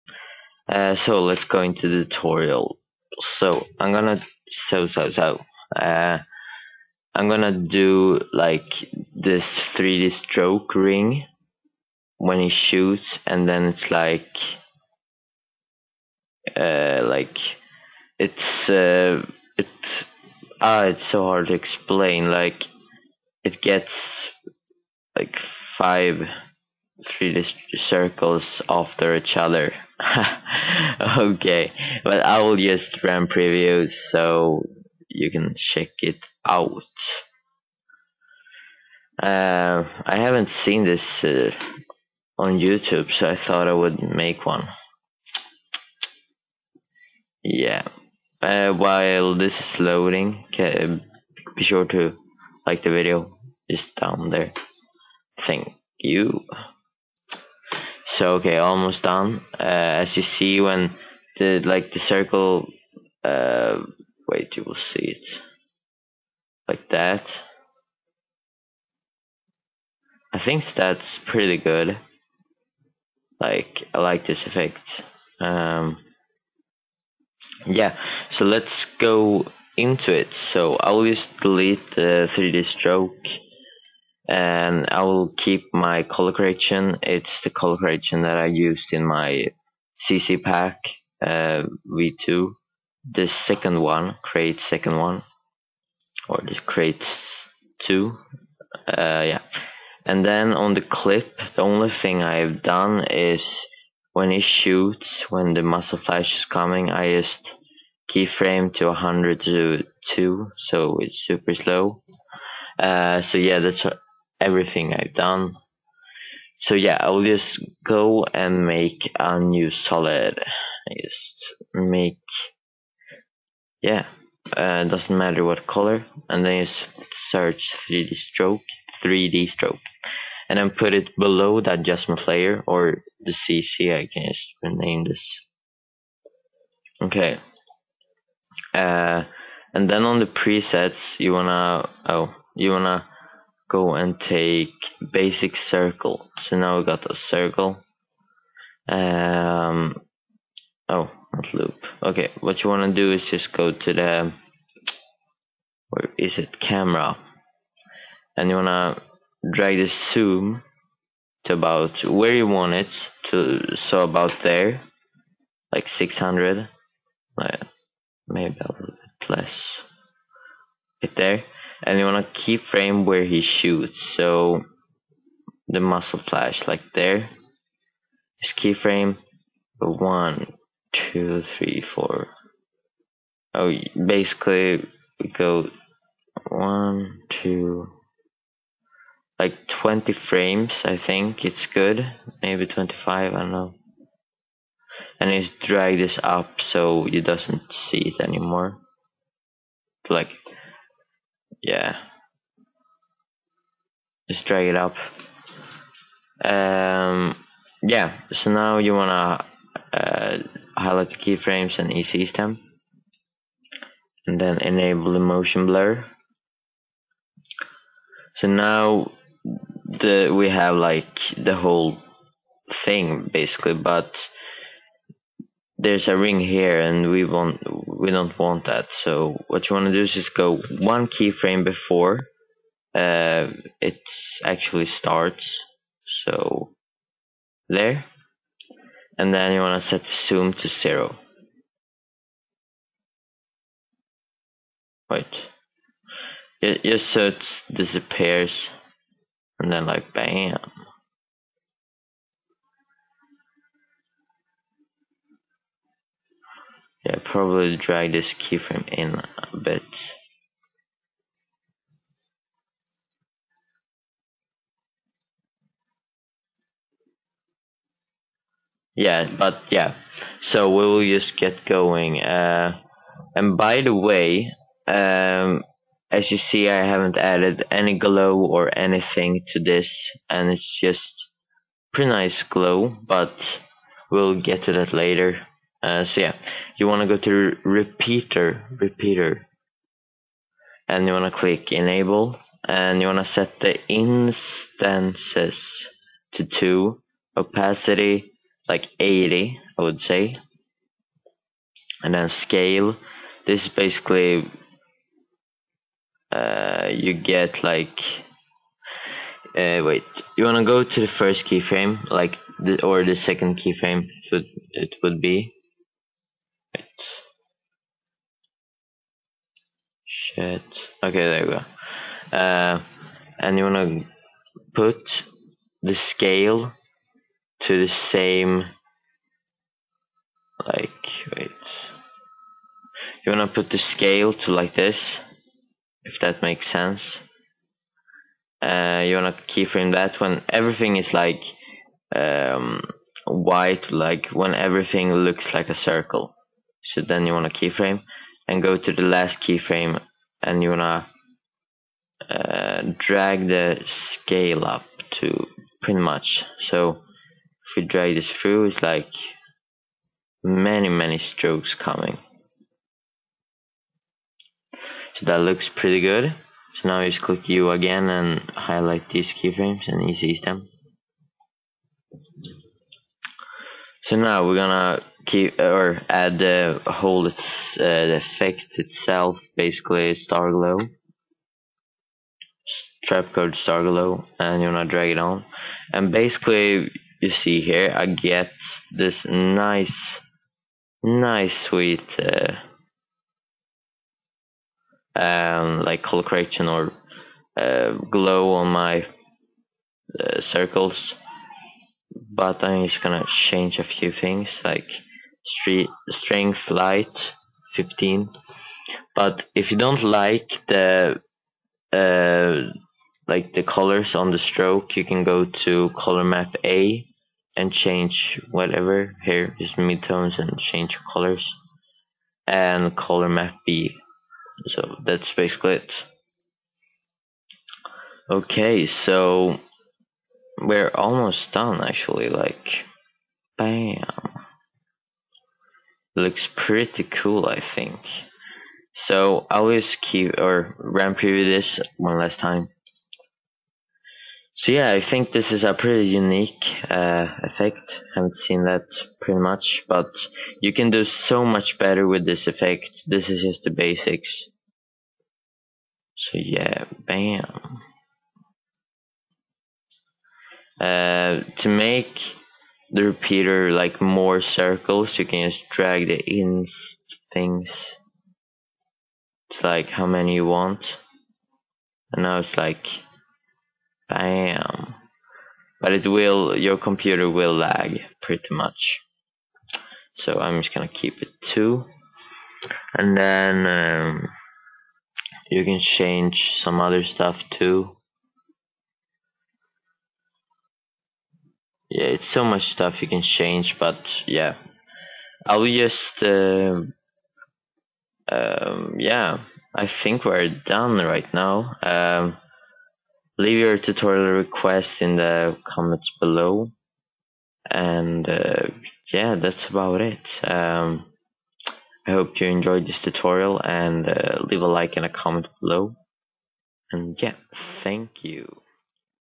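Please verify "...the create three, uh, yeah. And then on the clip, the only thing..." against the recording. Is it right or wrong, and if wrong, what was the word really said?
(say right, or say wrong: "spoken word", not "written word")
wrong: "two", not "three".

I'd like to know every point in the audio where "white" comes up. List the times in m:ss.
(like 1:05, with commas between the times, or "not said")
5:43.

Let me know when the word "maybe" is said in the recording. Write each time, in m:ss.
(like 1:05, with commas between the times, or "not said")
2:48, 3:12.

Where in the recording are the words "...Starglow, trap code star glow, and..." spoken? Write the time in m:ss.
6:20.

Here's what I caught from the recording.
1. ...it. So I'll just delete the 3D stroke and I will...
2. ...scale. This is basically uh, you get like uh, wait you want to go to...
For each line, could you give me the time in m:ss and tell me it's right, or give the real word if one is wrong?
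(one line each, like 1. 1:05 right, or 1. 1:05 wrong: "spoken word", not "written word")
1. 1:20 right
2. 5:02 right.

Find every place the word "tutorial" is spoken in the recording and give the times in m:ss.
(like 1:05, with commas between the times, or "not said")
0:02, 8:23, 8:32.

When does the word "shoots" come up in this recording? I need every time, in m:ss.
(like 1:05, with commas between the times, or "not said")
0:12, 1:44, 2:53.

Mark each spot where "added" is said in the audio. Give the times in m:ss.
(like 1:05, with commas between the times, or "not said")
4:37.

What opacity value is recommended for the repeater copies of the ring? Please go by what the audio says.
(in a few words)
80.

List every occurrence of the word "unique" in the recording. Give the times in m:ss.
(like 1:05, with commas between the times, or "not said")
7:26.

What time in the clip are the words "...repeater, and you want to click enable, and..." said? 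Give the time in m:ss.
4:48.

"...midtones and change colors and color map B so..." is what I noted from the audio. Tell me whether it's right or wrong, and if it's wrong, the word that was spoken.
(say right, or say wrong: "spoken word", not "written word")
right.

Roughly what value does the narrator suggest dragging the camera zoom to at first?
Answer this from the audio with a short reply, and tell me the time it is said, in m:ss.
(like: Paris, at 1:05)
600, at 2:45.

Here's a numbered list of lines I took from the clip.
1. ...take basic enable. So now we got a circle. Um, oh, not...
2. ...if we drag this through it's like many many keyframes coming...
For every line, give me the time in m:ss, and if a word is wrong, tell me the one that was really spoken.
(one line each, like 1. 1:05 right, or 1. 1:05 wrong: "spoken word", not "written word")
1. 2:24 wrong: "circle", not "enable"
2. 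5:56 wrong: "strokes", not "keyframes".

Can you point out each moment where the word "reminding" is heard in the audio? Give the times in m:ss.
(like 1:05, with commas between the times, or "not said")
not said.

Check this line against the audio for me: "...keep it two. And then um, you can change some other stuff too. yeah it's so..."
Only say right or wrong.
right.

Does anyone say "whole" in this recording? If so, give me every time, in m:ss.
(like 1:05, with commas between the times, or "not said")
3:41, 6:16.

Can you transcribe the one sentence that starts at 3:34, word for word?
And then enable the motion blur.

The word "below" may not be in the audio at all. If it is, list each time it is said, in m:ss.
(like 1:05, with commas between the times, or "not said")
2:11, 8:26, 8:35.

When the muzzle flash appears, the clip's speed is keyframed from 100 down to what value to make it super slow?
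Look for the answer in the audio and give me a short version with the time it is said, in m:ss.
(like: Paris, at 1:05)
2, at 1:48.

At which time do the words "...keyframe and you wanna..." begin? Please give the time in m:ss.
5:49.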